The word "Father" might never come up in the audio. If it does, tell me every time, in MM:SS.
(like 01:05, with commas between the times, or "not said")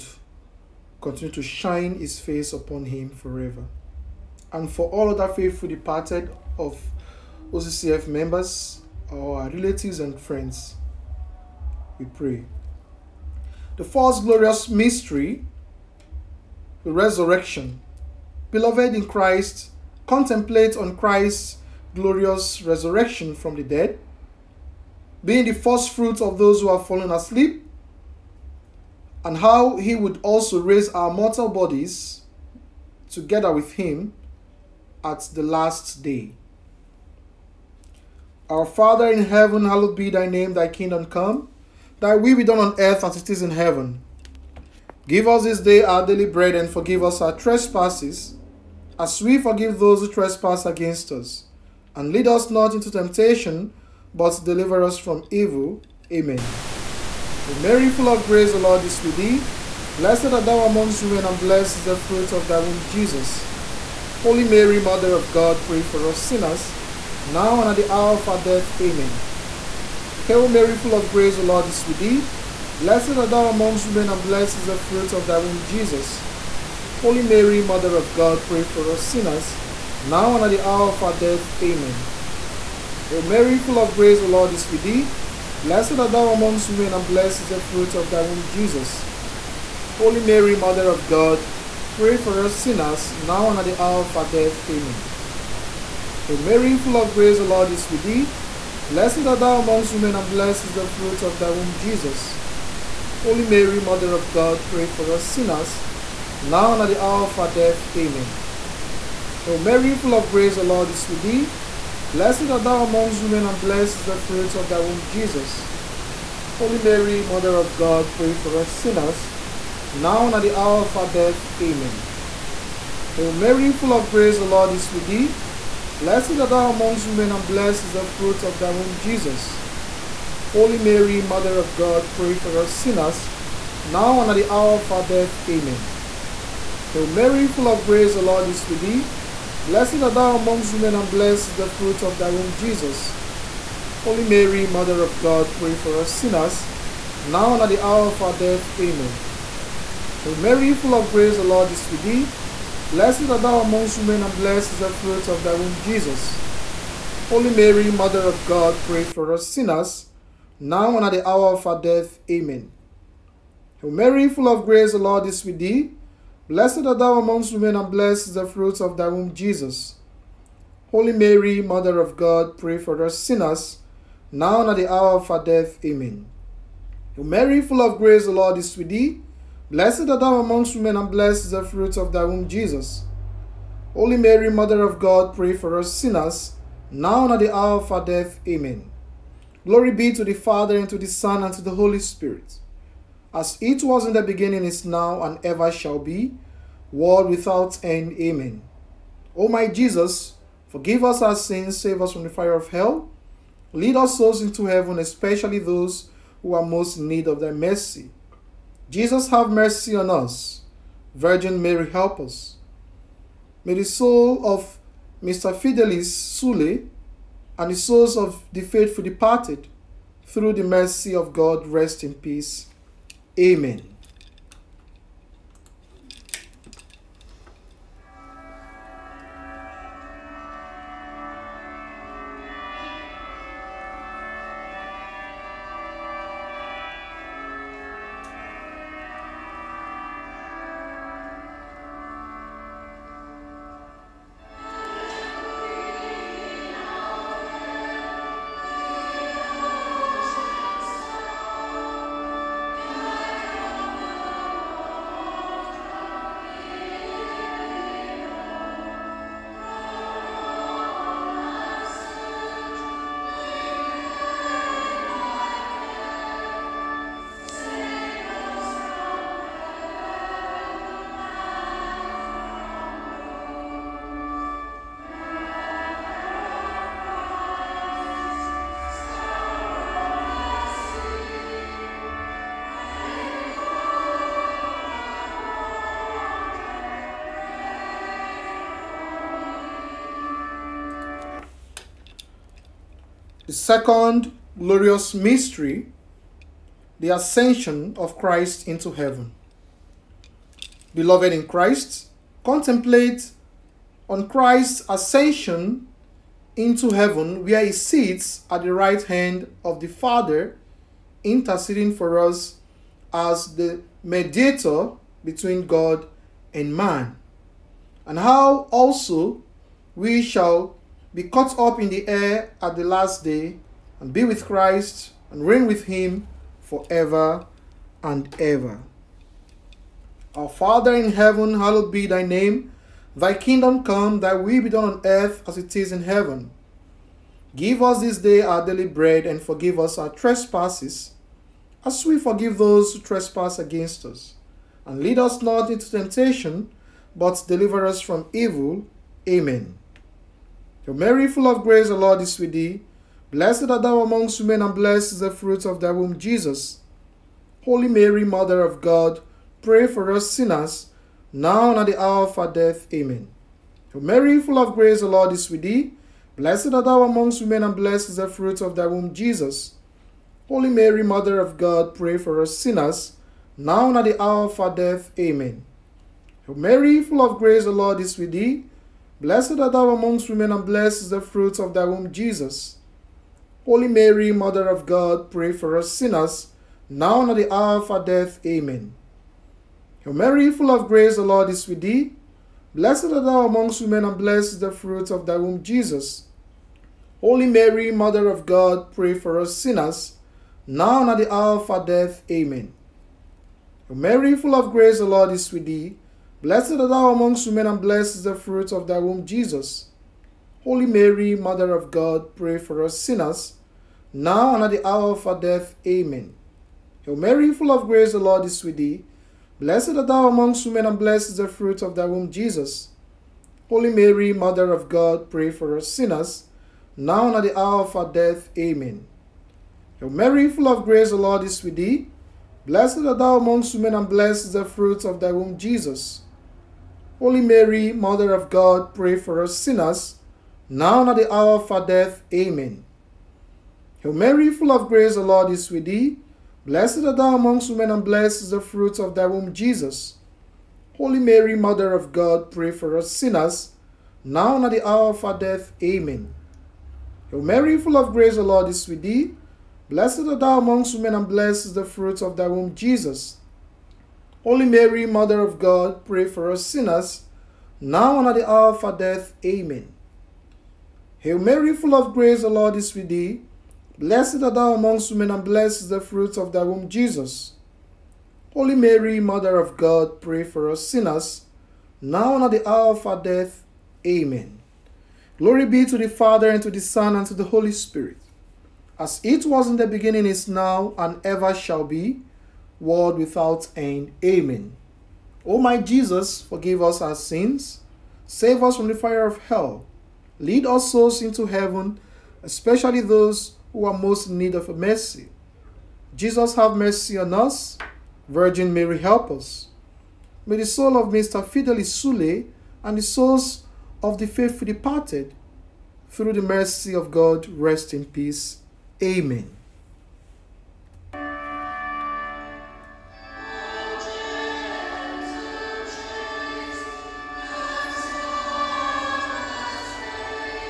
00:38, 03:10, 05:09, 05:30, 08:06.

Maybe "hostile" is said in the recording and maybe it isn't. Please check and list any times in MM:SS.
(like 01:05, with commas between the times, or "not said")
not said.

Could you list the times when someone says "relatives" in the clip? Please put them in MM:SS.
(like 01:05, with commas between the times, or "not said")
00:09.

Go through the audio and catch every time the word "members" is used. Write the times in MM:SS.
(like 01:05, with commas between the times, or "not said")
00:08.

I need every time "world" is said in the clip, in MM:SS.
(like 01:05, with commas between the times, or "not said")
03:16, 08:12.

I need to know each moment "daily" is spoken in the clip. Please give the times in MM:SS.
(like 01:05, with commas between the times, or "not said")
00:46, 05:38.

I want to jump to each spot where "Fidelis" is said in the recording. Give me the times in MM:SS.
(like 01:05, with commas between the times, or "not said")
03:35, 08:31.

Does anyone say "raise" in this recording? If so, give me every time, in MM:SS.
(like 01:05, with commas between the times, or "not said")
00:30.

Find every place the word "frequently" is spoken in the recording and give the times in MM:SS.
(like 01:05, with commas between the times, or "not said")
not said.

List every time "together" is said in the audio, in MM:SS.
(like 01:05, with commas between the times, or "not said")
00:33.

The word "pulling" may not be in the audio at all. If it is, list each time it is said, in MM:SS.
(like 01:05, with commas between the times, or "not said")
not said.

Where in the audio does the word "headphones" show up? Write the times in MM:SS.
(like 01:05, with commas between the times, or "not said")
not said.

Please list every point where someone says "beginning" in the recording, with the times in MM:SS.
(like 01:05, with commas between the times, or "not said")
03:14, 08:09.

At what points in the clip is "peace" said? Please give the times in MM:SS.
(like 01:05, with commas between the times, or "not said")
03:42, 08:38.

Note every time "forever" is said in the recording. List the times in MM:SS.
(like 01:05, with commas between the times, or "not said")
00:03, 05:26.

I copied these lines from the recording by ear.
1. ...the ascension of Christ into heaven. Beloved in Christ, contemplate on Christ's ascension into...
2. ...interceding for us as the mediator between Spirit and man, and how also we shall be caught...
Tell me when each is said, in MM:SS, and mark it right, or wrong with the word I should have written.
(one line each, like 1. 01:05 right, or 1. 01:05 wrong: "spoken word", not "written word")
1. 04:56 right
2. 05:11 wrong: "God", not "Spirit".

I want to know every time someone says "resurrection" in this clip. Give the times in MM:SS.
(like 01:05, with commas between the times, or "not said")
00:16, 00:22.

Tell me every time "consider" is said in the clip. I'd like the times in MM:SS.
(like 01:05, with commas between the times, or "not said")
not said.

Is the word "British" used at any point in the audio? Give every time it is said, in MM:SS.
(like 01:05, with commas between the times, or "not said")
not said.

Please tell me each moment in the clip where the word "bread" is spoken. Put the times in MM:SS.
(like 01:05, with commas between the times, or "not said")
00:46, 05:38.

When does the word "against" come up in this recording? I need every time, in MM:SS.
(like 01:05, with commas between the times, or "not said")
00:50, 05:43.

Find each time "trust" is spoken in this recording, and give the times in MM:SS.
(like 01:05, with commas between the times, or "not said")
not said.